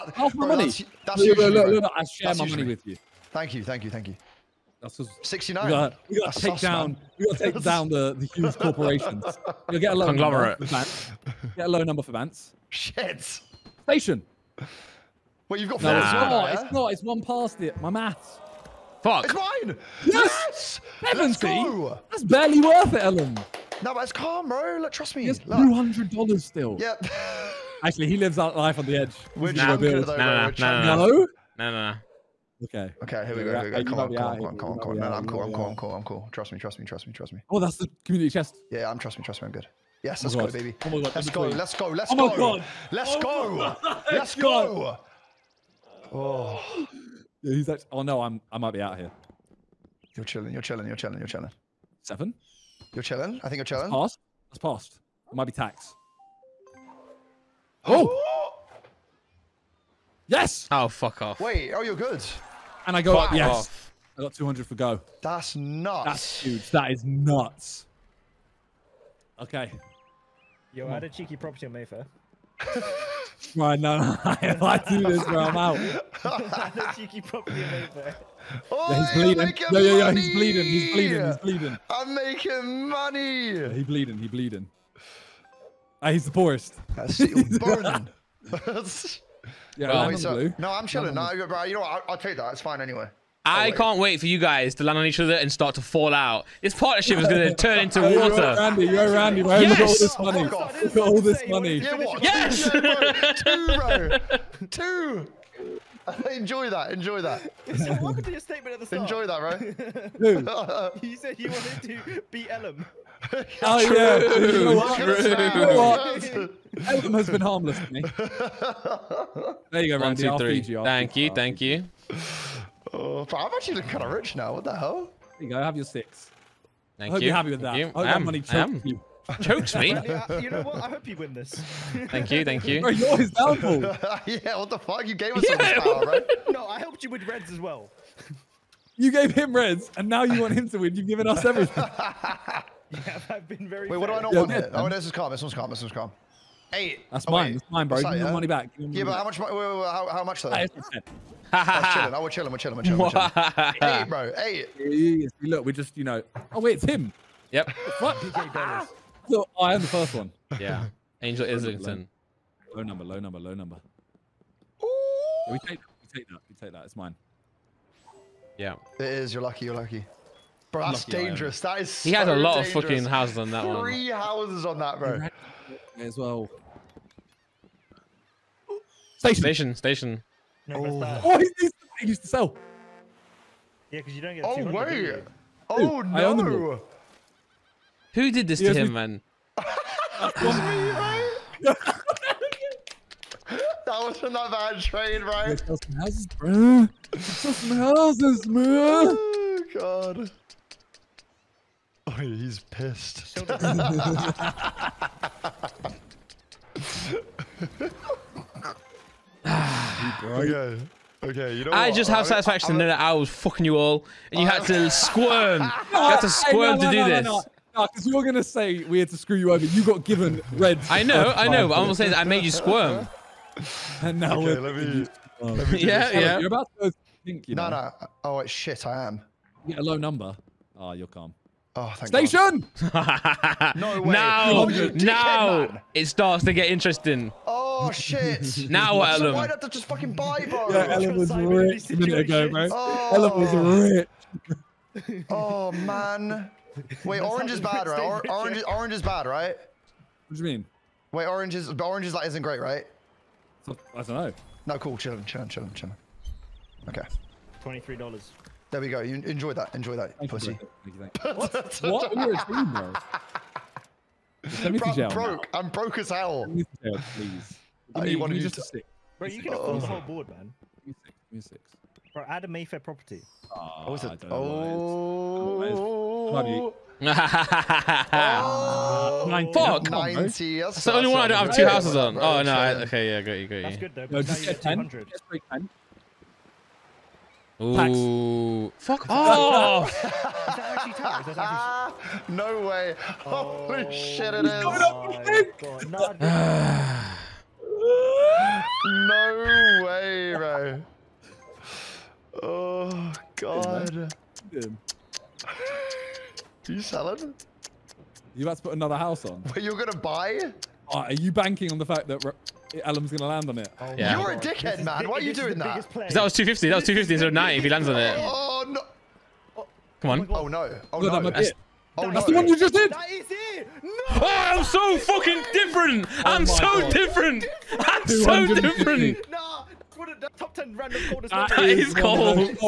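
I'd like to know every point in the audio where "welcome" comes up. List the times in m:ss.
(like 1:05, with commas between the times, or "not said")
1:48.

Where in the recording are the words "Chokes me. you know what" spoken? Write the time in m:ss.
2:09.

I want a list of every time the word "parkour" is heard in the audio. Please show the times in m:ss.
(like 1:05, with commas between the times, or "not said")
not said.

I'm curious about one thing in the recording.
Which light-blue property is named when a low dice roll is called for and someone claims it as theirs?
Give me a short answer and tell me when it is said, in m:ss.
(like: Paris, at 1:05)
Angel Islington, at 2:41.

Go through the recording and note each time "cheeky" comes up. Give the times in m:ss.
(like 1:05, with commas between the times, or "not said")
1:11, 1:16.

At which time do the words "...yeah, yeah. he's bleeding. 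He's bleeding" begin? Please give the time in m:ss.
1:19.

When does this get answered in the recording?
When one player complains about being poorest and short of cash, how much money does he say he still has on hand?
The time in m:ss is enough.
4:17.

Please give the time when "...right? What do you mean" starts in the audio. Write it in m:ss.
4:09.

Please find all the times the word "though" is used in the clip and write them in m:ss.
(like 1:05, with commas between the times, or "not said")
0:29, 2:30, 4:43.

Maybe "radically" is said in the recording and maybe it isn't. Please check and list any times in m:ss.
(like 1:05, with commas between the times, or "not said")
not said.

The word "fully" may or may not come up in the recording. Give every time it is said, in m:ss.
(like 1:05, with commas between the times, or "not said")
not said.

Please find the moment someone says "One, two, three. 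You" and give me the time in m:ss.
2:00.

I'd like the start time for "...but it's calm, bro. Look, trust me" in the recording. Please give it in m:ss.
0:23.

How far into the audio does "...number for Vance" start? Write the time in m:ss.
0:11.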